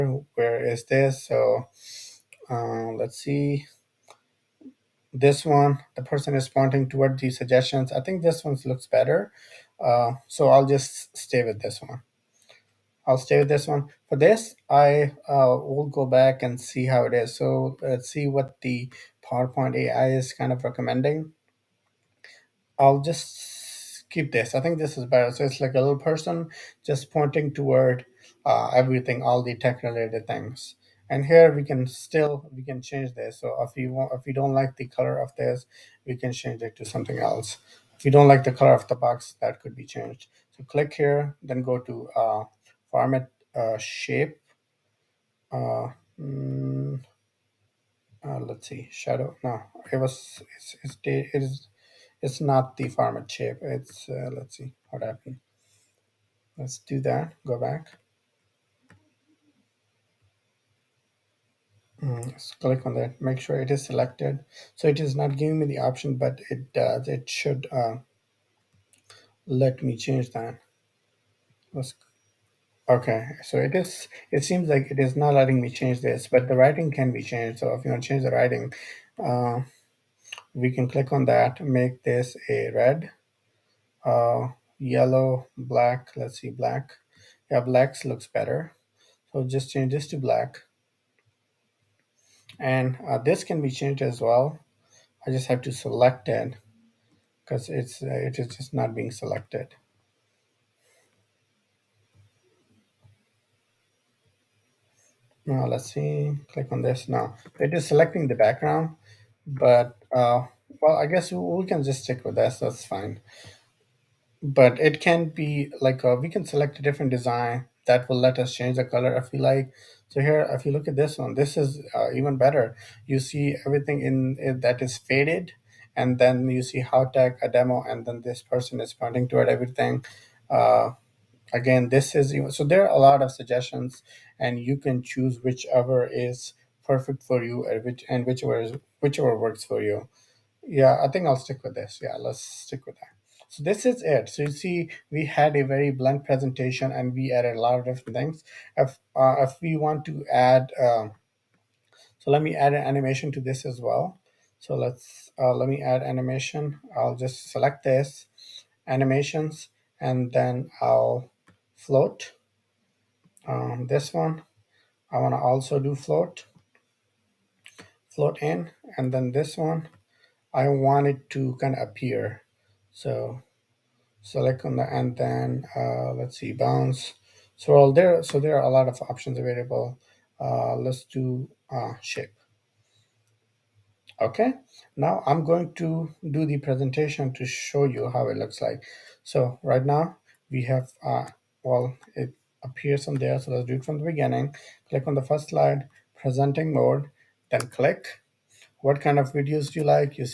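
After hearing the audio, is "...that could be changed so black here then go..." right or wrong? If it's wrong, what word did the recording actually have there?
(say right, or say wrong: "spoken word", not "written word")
wrong: "click", not "black".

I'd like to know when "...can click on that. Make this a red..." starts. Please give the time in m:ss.
1:20.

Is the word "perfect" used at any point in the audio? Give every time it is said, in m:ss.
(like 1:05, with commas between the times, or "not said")
2:16.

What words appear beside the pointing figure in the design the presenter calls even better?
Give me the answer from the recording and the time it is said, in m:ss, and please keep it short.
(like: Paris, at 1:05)
tech a demo, at 2:07.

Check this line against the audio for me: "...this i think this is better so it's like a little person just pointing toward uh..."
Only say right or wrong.
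right.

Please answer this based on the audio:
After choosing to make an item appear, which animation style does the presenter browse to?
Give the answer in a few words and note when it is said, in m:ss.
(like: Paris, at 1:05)
bounce, at 2:56.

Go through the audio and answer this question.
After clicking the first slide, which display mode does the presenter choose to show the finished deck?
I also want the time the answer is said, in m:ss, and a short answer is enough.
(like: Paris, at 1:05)
presenting mode, at 3:16.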